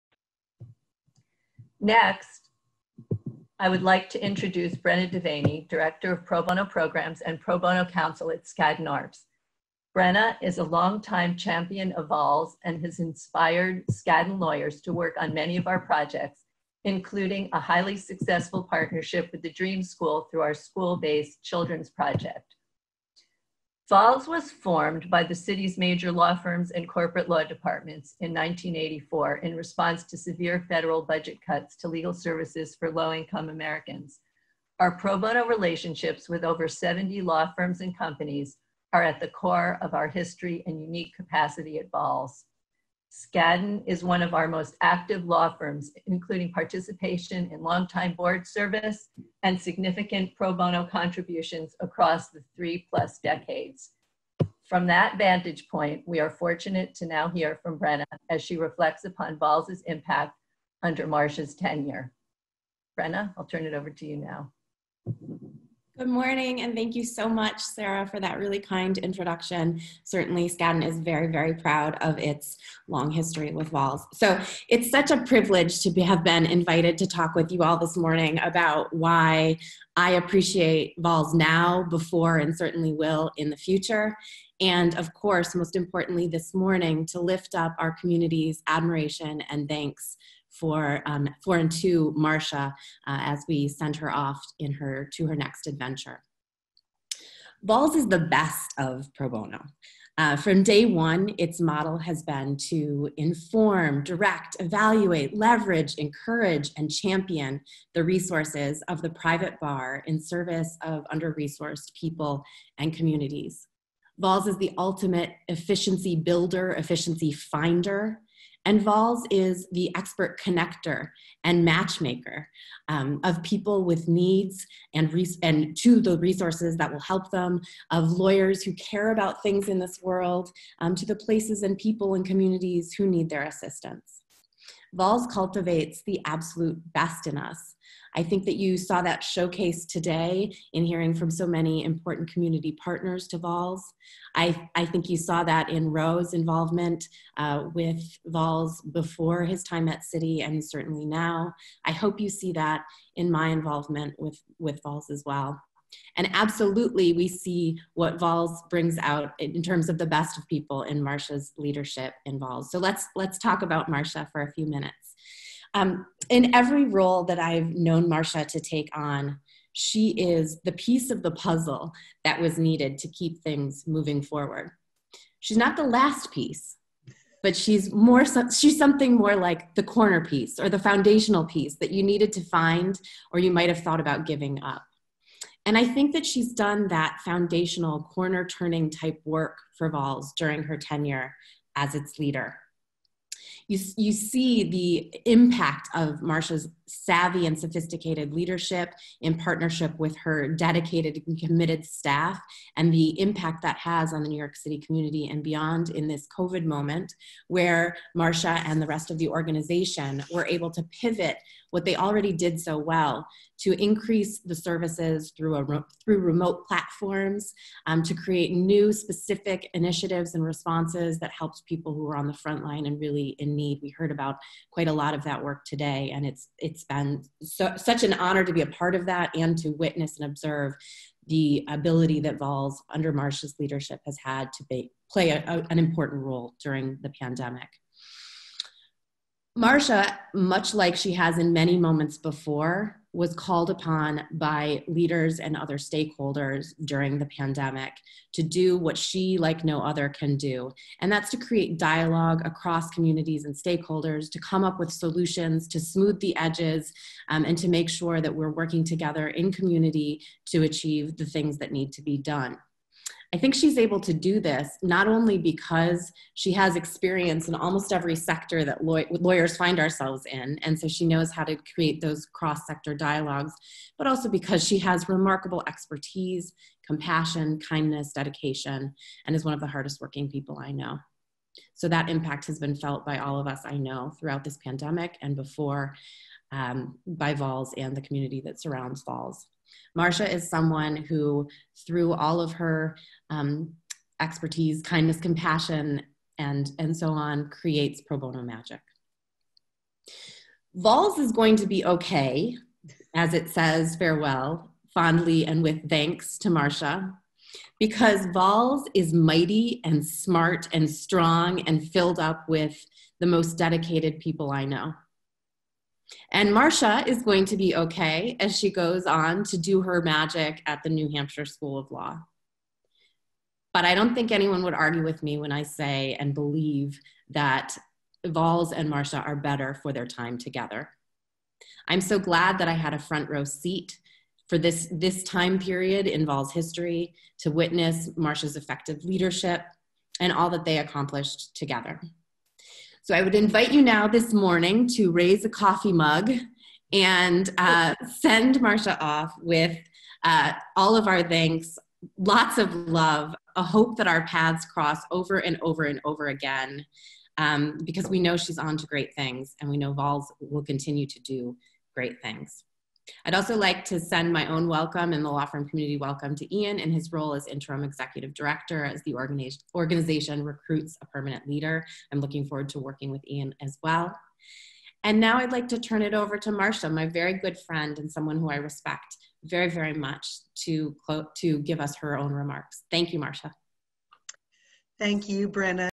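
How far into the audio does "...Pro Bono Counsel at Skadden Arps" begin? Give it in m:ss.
0:07.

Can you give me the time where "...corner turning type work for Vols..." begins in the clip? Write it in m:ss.
3:08.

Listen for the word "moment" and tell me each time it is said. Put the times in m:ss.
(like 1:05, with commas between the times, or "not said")
3:26, 4:01.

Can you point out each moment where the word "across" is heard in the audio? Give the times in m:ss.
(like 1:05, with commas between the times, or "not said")
0:51, 4:12.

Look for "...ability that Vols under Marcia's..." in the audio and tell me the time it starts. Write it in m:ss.
3:51.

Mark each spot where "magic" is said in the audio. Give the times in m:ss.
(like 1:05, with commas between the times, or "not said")
4:58, 5:20.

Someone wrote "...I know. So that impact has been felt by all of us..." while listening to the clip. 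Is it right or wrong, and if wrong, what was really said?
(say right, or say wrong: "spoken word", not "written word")
right.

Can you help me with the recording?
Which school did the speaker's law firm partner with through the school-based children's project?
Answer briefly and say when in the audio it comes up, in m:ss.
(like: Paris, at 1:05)
the Dream School, at 0:19.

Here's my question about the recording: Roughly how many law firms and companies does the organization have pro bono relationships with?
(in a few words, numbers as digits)
over 70.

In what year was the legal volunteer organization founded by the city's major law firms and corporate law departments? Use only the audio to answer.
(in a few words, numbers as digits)
1984.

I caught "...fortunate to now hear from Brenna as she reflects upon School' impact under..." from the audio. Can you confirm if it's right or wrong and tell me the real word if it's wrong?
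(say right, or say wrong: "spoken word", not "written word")
wrong: "Vols", not "School".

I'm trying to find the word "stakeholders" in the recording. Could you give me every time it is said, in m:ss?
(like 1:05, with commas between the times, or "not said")
4:05, 4:13.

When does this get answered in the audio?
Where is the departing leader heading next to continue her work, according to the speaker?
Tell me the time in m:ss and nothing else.
5:20.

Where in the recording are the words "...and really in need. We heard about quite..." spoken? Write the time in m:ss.
3:42.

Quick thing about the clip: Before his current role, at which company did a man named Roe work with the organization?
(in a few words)
Citi.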